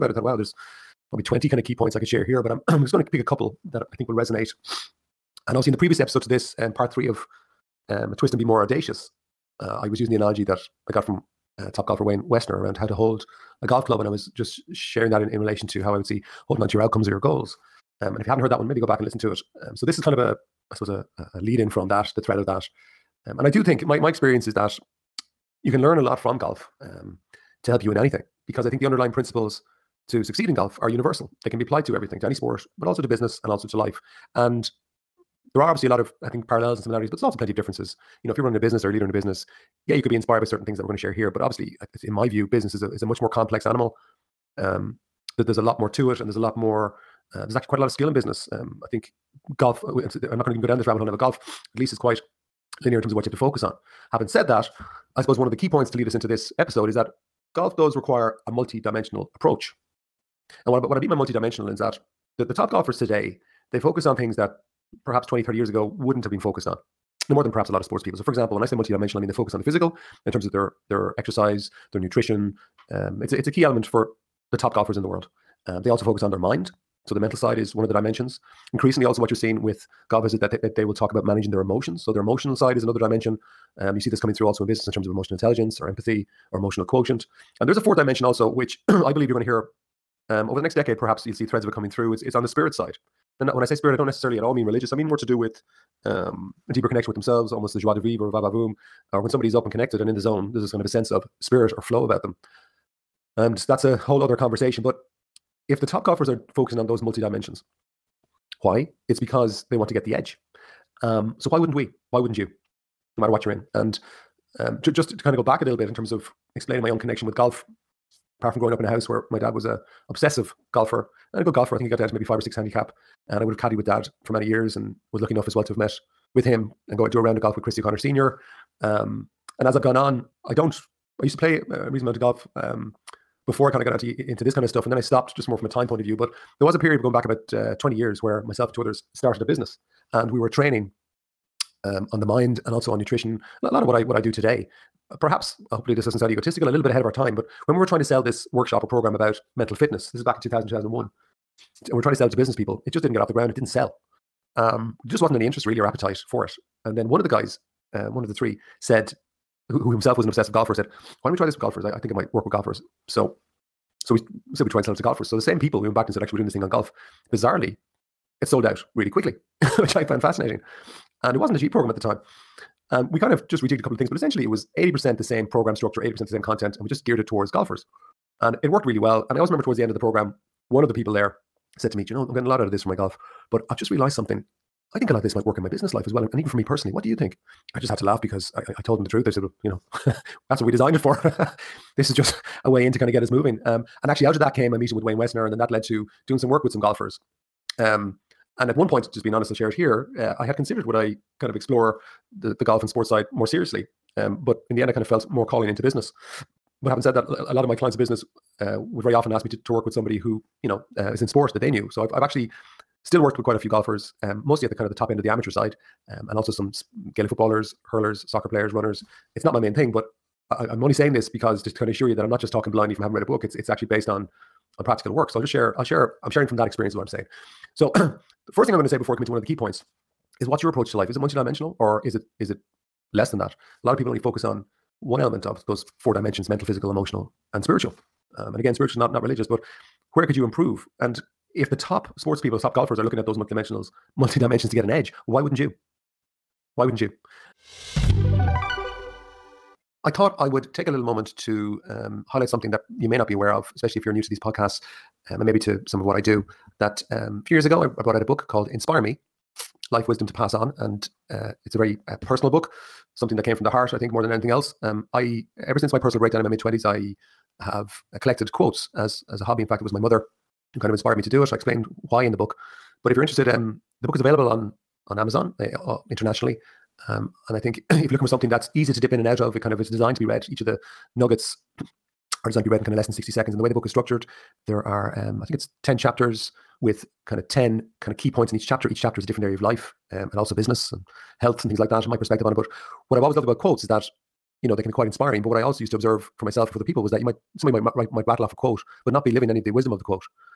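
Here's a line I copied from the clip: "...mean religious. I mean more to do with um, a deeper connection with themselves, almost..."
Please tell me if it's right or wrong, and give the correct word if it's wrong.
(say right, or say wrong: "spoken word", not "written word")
right.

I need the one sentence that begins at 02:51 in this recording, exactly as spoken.
And it wasn't a cheap program at the time.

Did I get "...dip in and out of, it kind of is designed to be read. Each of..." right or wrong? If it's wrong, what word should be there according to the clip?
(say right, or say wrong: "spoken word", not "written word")
right.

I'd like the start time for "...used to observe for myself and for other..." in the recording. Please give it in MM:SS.
04:55.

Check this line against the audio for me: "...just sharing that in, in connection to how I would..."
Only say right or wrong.
wrong.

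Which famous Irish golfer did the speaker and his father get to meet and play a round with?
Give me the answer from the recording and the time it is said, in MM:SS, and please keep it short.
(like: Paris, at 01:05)
Christy O'Connor Senior, at 02:07.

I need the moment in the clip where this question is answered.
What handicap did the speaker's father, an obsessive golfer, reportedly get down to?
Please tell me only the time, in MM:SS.
02:02.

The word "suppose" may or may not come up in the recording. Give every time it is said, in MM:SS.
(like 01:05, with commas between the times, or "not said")
00:20, 00:55.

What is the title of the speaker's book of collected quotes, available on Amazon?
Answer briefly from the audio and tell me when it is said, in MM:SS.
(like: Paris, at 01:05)
Inspire Me Life Wisdom to Pass On, at 04:18.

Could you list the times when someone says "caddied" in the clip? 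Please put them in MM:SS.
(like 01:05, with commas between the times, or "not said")
02:03.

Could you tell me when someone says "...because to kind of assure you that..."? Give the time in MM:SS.
03:41.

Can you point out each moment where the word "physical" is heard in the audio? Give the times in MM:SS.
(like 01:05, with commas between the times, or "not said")
01:09, 03:56.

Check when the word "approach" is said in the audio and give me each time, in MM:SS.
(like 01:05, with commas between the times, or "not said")
00:59, 03:50.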